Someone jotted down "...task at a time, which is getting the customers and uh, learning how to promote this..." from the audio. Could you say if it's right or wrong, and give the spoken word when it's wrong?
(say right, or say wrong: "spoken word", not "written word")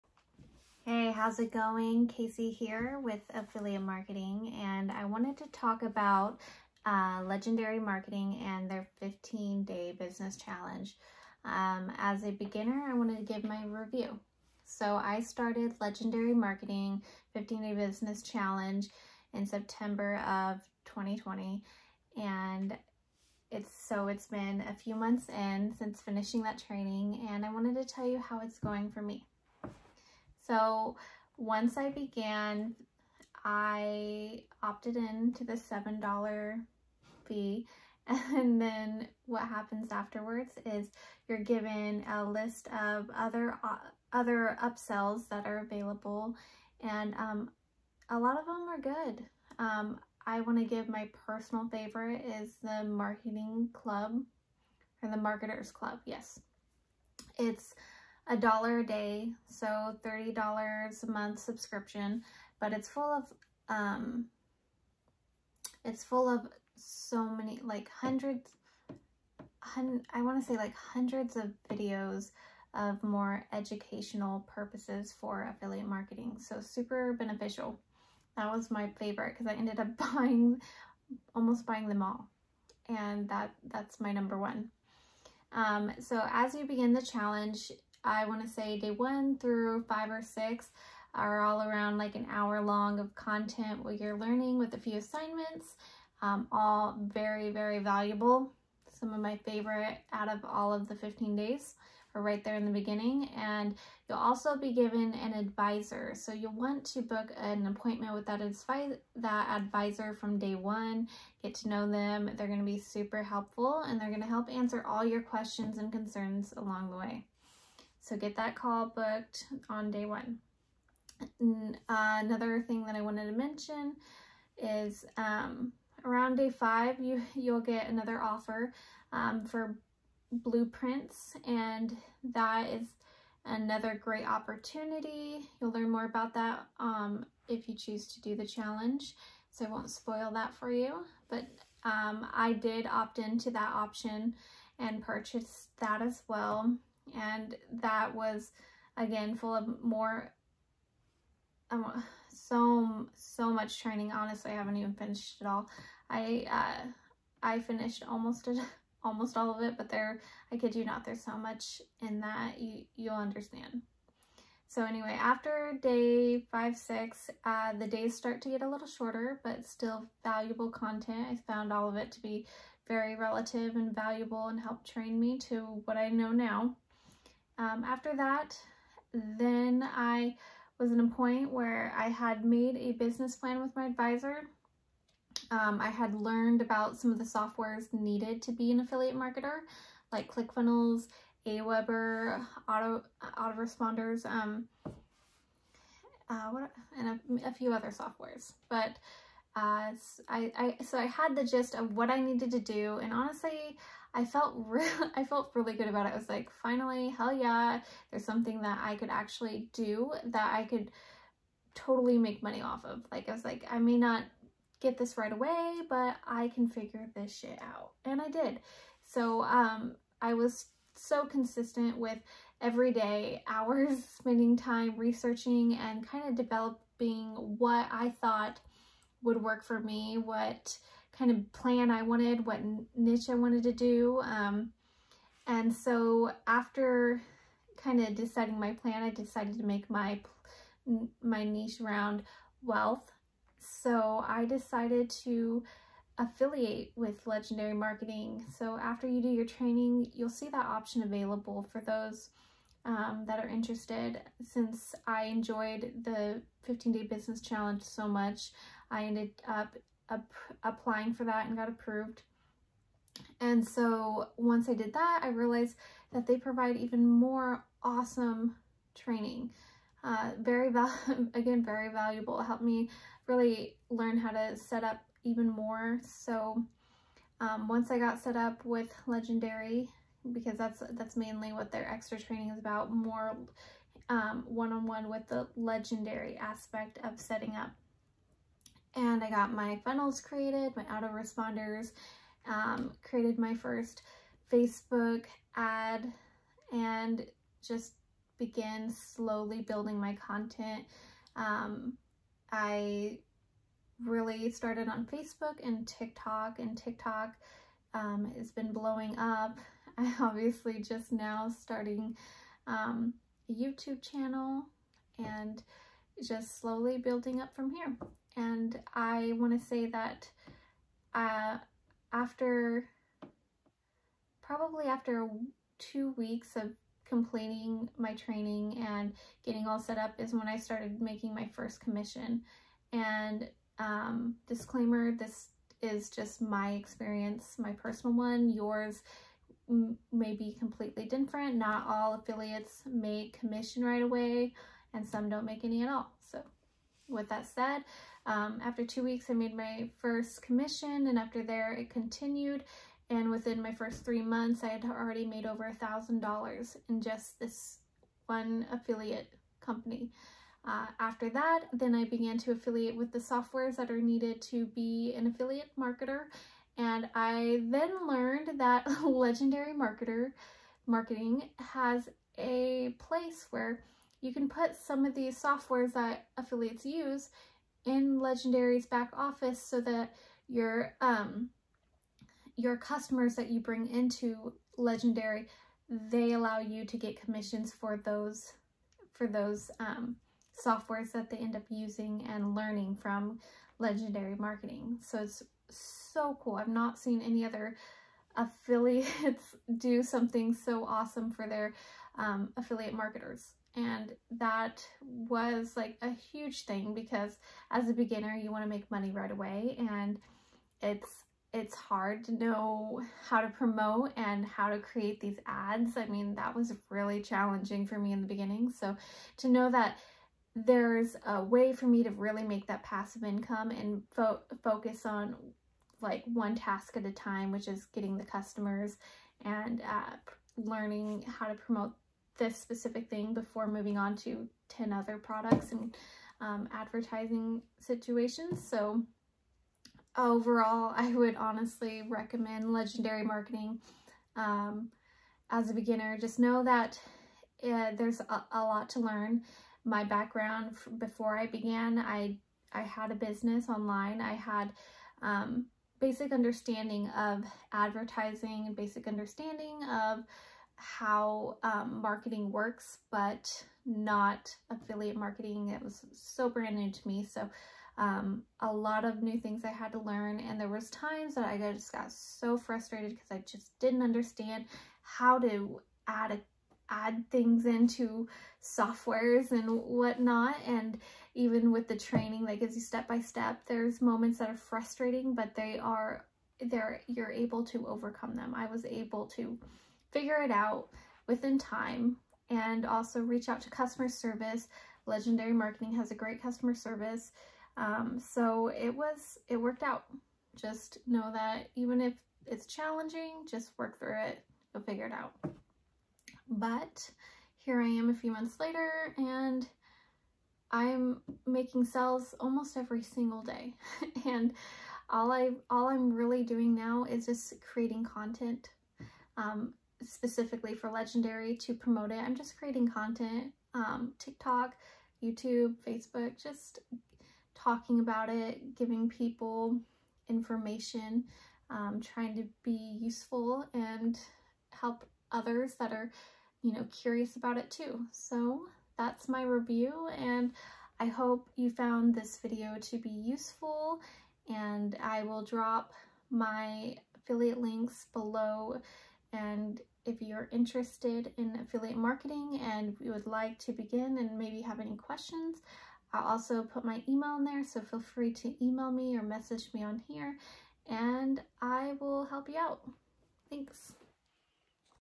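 right.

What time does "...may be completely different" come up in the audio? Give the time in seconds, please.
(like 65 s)
340 s.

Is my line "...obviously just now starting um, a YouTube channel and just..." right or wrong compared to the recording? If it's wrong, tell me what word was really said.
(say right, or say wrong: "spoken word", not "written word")
right.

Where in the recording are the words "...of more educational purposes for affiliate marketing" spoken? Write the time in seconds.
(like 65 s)
72 s.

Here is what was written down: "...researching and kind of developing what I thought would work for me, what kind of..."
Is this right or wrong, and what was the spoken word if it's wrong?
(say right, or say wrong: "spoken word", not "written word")
right.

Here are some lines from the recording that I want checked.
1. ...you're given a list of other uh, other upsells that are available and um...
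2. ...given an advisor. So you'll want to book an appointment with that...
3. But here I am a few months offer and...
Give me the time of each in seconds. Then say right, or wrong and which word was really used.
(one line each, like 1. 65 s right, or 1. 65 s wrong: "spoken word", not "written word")
1. 41 s right
2. 104 s right
3. 506 s wrong: "later", not "offer".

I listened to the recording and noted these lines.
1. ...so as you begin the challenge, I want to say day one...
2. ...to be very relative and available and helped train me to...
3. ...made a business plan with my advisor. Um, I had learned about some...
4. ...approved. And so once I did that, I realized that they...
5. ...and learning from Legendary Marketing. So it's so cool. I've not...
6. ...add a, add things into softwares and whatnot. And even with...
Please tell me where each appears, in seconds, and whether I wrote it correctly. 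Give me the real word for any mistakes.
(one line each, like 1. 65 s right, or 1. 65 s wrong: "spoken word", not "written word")
1. 85 s right
2. 172 s wrong: "valuable", not "available"
3. 182 s right
4. 261 s right
5. 392 s right
6. 476 s right.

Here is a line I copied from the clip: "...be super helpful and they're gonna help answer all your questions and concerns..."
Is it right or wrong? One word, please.
right.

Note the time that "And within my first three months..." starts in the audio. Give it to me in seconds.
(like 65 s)
353 s.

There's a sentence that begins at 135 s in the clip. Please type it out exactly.
You'll learn more about that um, if you choose to do the challenge.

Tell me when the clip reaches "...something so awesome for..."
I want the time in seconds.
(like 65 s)
400 s.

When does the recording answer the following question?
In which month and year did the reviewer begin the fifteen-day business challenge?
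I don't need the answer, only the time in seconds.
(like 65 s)
19 s.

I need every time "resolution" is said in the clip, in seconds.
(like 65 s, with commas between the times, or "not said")
not said.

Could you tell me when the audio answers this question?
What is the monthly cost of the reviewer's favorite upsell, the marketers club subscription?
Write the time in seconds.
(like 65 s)
60 s.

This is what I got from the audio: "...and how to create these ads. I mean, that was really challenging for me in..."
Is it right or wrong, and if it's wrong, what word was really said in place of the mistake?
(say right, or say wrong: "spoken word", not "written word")
right.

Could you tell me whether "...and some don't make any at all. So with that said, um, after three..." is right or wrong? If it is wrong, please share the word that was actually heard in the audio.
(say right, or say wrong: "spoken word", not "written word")
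wrong: "two", not "three".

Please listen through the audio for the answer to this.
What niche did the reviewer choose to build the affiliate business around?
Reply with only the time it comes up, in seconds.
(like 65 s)
242 s.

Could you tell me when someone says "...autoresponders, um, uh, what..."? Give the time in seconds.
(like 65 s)
193 s.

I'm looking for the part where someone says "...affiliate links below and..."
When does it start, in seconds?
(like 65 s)
547 s.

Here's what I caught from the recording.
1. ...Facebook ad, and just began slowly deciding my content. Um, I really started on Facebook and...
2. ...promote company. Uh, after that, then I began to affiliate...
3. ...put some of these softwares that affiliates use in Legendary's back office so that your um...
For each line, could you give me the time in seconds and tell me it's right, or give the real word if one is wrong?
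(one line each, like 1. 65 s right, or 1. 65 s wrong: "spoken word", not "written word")
1. 294 s wrong: "building", not "deciding"
2. 358 s wrong: "affiliate", not "promote"
3. 374 s right.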